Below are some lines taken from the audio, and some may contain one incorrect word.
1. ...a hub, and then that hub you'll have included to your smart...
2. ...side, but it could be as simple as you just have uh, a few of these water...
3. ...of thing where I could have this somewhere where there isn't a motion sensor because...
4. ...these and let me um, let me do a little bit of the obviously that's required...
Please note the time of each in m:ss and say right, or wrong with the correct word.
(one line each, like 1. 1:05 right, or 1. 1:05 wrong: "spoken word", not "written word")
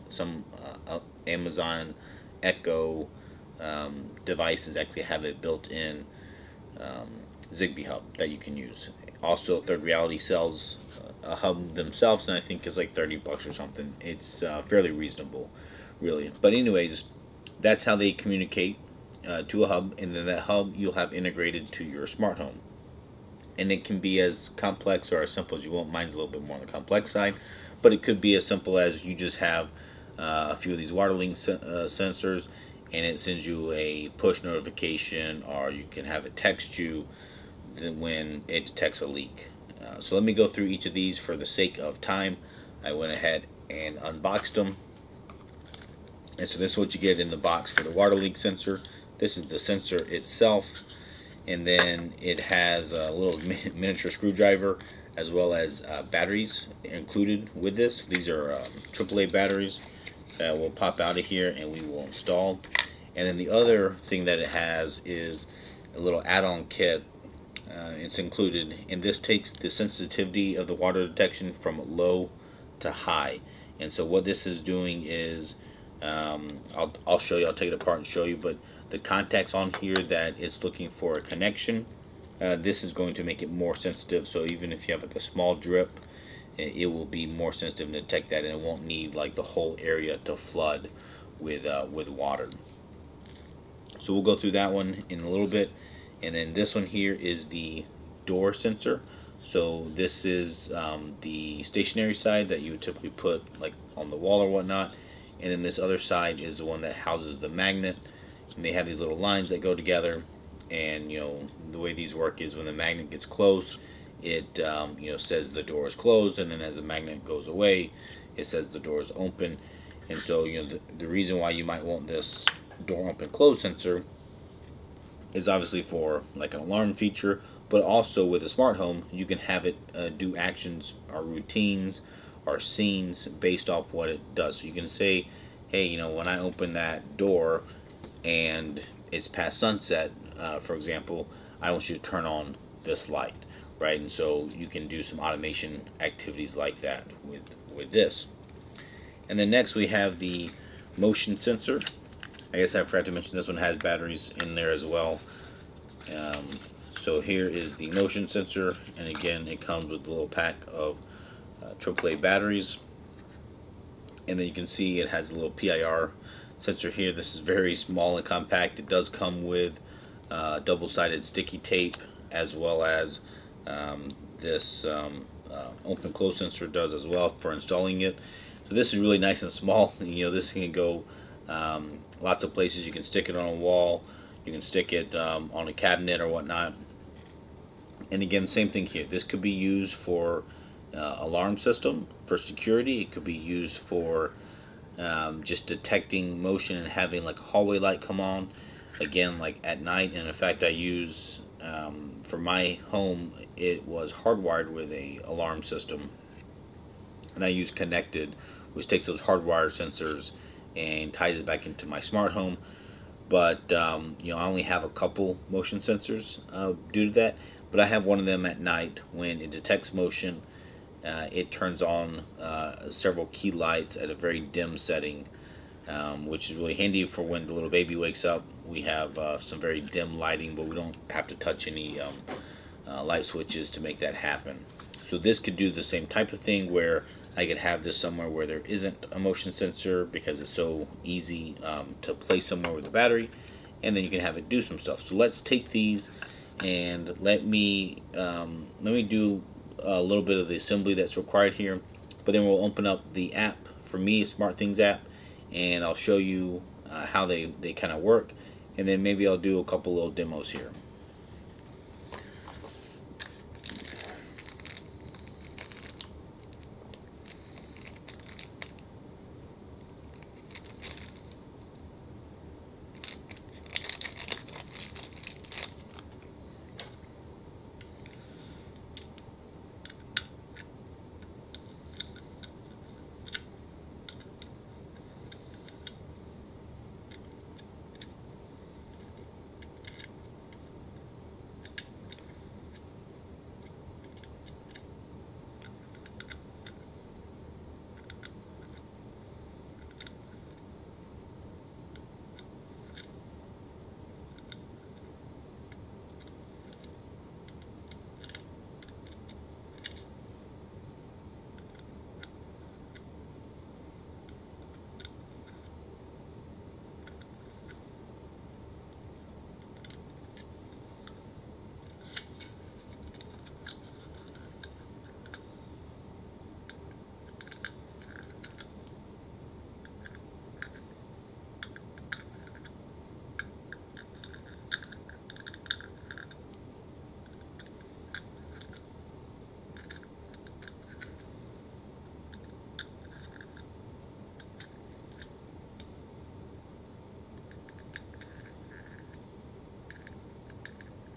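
1. 0:19 wrong: "integrated", not "included"
2. 0:27 right
3. 3:56 right
4. 4:05 wrong: "assembly", not "obviously".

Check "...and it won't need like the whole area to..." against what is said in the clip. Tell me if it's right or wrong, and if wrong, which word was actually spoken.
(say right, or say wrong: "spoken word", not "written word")
right.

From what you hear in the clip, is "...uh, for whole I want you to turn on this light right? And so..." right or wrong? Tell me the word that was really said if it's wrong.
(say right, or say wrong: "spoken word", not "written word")
wrong: "example", not "whole".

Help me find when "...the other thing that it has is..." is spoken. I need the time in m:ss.
1:03.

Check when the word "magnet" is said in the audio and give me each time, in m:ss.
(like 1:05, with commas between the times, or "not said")
1:47, 1:52, 1:56.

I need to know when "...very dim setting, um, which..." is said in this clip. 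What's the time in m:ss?
3:44.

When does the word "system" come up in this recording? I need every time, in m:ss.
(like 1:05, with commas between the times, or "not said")
3:11, 3:25.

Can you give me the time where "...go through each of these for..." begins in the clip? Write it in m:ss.
0:40.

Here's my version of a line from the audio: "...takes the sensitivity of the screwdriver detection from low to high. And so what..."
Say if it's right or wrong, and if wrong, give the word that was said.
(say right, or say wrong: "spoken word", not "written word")
wrong: "water", not "screwdriver".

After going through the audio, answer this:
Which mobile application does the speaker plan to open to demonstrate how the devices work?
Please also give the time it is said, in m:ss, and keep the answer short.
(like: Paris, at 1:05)
SmartThings, at 4:14.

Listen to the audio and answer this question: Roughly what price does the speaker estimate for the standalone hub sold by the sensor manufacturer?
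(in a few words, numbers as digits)
$30.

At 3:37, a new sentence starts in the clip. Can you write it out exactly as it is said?
But I have one of them at night when it detects motion.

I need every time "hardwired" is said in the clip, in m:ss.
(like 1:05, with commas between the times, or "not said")
3:24, 3:29.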